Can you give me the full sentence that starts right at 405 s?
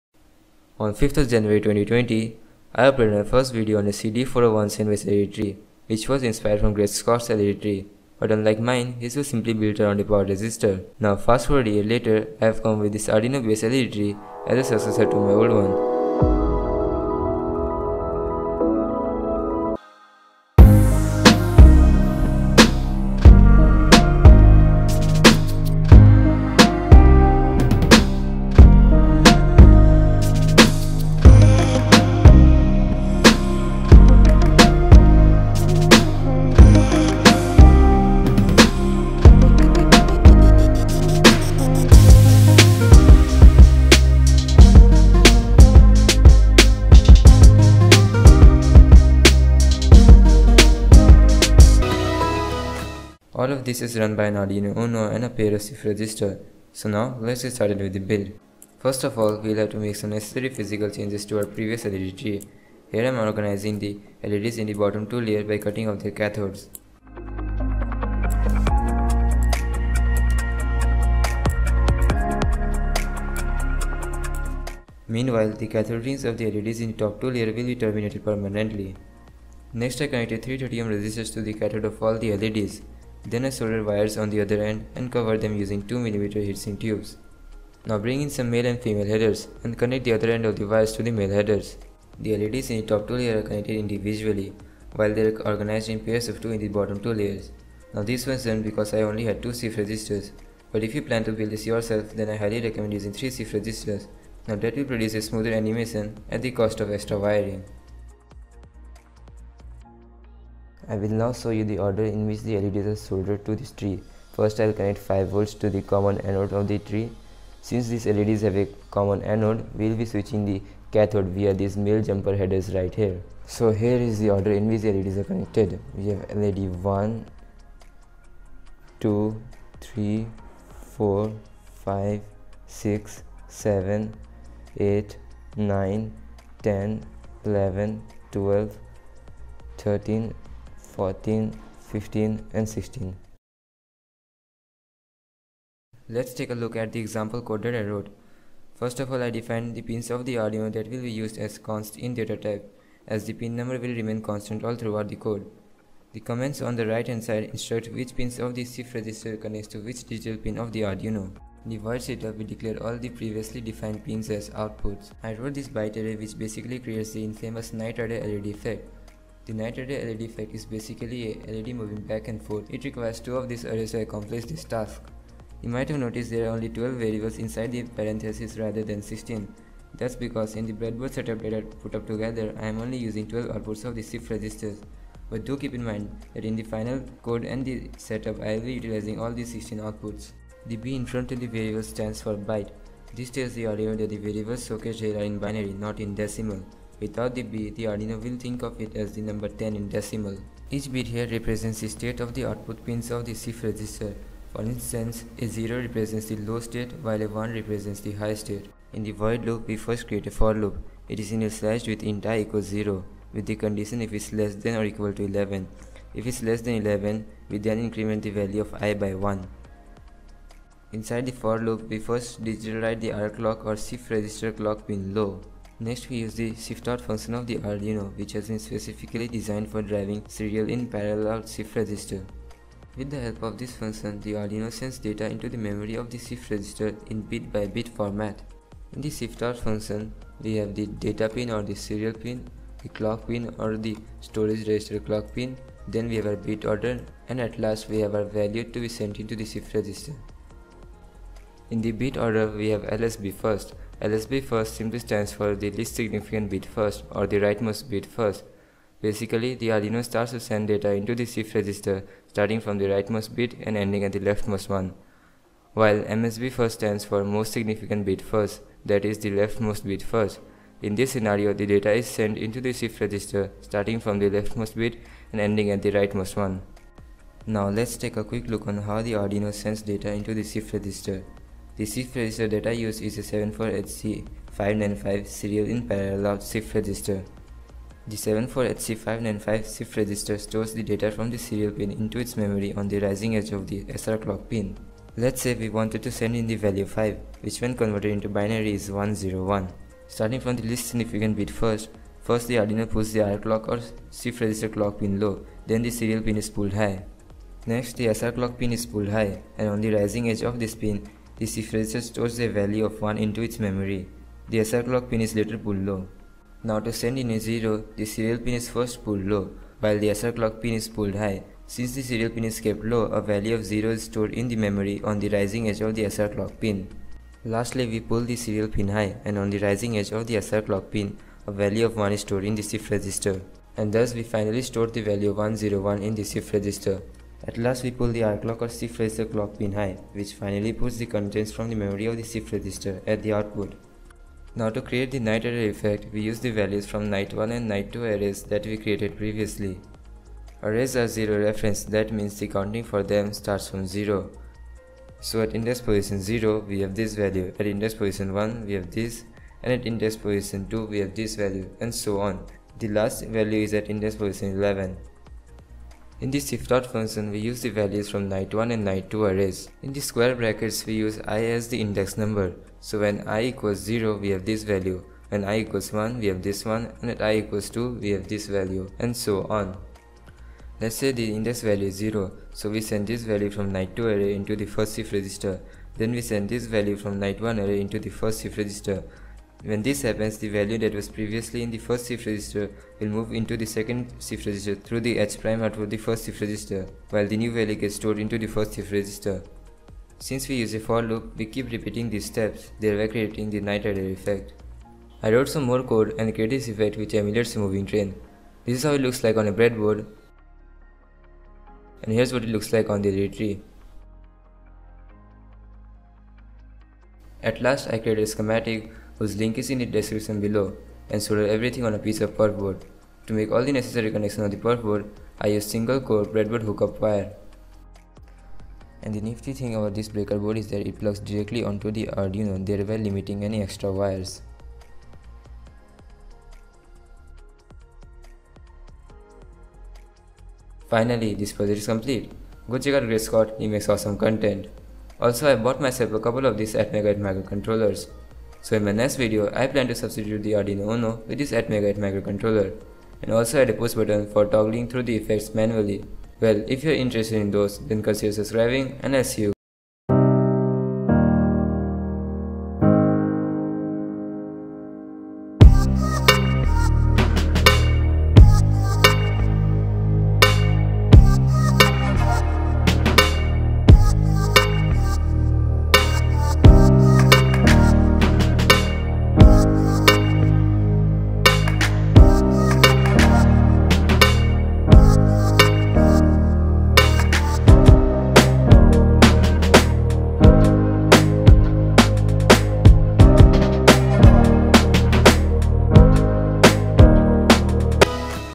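I wrote some more code and created this effect which emulates a moving train.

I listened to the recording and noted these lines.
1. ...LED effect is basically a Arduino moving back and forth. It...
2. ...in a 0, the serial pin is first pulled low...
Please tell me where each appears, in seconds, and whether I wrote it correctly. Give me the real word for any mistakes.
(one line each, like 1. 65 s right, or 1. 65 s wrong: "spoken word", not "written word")
1. 170 s wrong: "LED", not "Arduino"
2. 317 s right.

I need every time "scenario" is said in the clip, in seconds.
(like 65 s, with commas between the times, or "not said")
271 s.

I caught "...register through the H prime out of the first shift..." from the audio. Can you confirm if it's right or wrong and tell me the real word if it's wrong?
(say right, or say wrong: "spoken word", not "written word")
right.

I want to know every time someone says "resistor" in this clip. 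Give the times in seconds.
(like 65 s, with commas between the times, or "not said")
10 s, 80 s.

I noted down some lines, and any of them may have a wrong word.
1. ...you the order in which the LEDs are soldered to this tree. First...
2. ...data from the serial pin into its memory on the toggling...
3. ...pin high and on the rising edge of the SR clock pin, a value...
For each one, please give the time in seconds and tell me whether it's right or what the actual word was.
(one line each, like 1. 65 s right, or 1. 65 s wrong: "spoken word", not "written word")
1. 111 s right
2. 290 s wrong: "rising", not "toggling"
3. 328 s right.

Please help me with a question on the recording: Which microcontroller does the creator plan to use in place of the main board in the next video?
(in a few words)
ATmega8.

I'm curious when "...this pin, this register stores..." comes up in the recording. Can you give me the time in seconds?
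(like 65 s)
310 s.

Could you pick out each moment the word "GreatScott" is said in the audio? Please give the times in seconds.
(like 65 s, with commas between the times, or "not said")
6 s, 443 s.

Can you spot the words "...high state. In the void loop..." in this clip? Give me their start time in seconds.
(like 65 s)
208 s.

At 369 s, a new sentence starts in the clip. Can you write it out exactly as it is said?
In the square brackets, we use i as the index number.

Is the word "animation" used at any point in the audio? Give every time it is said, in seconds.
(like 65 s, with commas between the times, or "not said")
105 s.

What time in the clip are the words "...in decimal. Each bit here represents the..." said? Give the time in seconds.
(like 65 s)
199 s.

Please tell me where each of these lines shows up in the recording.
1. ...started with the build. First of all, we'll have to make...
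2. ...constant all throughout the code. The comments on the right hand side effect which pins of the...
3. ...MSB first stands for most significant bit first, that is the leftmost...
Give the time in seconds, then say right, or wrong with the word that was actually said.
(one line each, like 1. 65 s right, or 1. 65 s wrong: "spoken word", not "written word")
1. 57 s right
2. 154 s wrong: "instruct", not "effect"
3. 266 s right.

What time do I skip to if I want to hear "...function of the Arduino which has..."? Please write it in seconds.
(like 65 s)
227 s.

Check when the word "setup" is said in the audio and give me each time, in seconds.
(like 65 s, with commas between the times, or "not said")
162 s, 181 s, 187 s.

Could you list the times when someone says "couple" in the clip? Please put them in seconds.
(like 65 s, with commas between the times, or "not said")
446 s.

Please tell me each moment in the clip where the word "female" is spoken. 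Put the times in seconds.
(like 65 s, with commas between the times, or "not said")
88 s.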